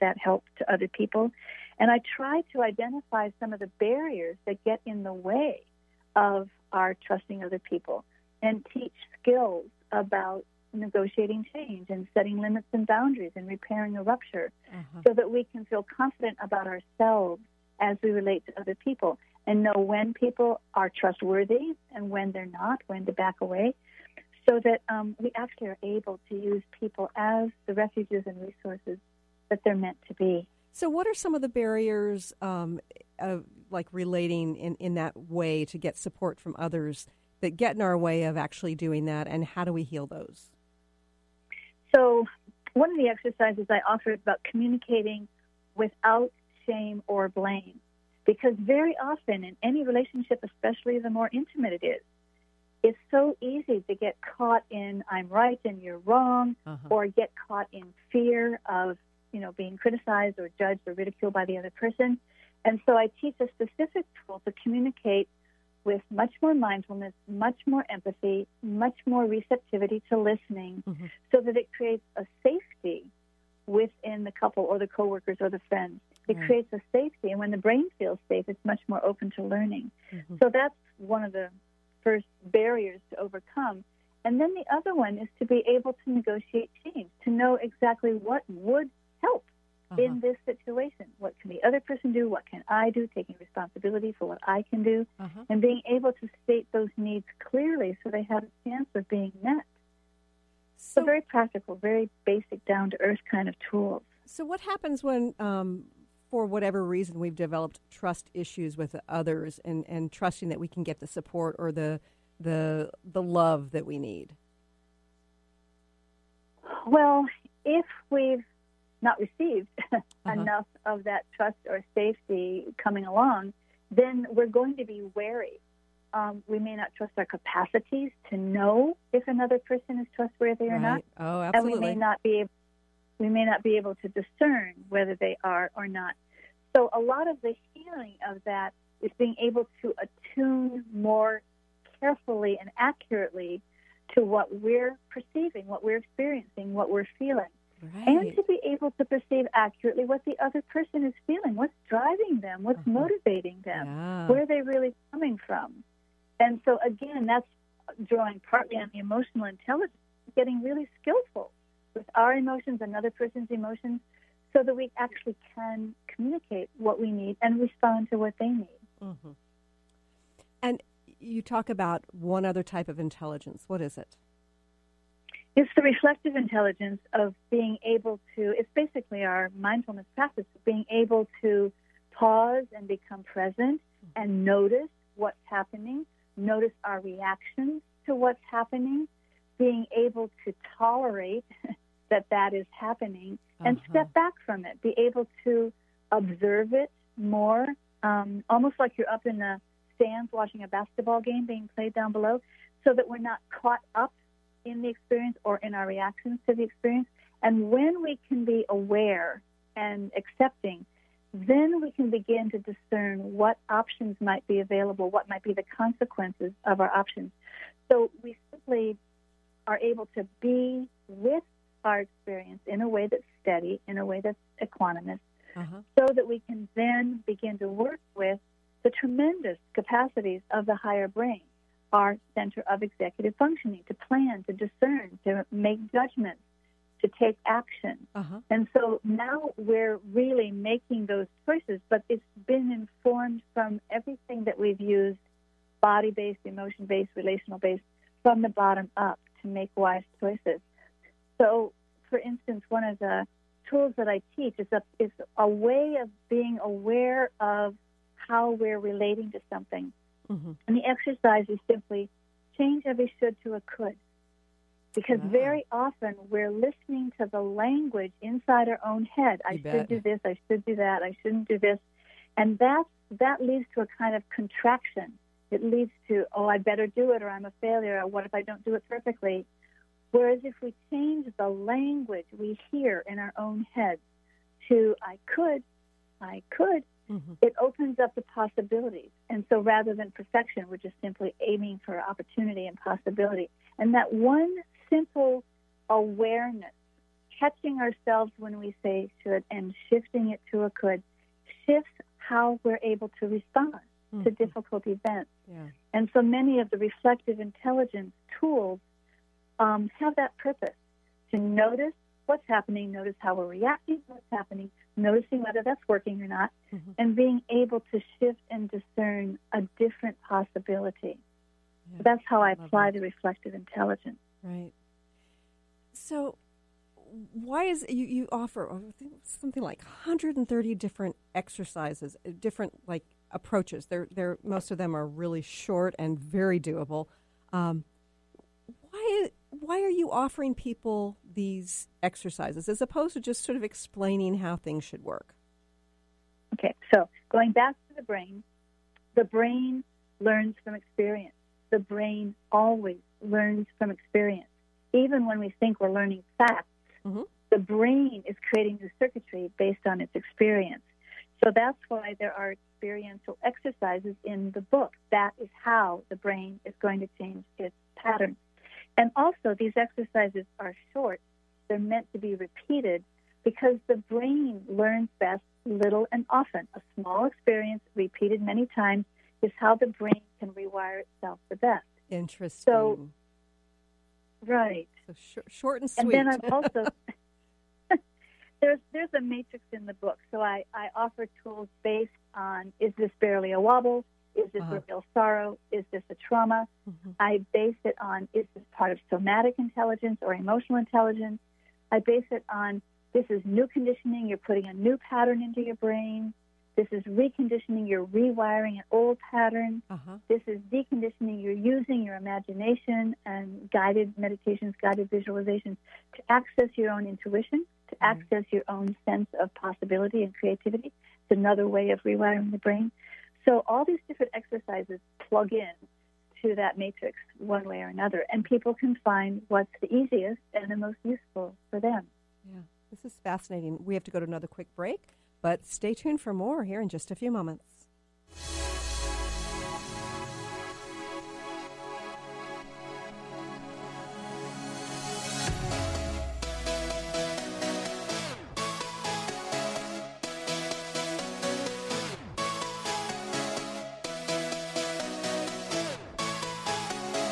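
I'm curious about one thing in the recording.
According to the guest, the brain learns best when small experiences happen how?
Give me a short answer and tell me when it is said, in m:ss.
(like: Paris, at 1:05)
little and often, at 6:15.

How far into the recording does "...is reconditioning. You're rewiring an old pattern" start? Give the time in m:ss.
6:46.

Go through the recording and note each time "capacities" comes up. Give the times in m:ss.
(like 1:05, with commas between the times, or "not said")
2:07, 3:49.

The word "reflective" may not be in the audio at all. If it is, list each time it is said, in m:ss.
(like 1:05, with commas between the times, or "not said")
2:55, 5:06, 5:23.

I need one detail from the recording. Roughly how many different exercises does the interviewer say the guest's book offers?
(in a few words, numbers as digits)
130.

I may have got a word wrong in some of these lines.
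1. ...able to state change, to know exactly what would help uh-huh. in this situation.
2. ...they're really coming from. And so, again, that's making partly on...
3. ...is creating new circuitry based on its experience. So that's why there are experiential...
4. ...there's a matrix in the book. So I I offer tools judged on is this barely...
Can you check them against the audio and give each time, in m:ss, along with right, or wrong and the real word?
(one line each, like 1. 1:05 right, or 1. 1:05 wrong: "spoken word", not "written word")
1. 1:25 wrong: "negotiate", not "state"
2. 2:34 wrong: "drawing", not "making"
3. 5:58 right
4. 6:28 wrong: "based", not "judged".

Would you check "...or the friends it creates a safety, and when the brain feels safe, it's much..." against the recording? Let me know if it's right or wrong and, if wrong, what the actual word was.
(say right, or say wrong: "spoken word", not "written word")
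right.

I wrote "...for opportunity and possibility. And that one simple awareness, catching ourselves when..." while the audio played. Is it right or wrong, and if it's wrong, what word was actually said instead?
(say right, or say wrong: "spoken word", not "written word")
right.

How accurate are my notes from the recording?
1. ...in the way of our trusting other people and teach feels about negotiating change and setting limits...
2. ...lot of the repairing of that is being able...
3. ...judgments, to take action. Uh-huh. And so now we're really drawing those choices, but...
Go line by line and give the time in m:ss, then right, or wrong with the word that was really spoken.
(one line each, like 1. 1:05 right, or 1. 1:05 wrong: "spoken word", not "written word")
1. 0:04 wrong: "skills", not "feels"
2. 2:16 wrong: "healing", not "repairing"
3. 3:55 wrong: "making", not "drawing".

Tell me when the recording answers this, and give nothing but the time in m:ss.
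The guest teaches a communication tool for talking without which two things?
0:46.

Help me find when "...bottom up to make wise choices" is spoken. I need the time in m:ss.
4:08.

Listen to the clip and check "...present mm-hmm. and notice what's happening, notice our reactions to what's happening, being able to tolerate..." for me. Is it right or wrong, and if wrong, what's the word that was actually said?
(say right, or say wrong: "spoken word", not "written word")
right.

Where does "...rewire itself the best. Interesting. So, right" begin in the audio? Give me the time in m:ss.
6:20.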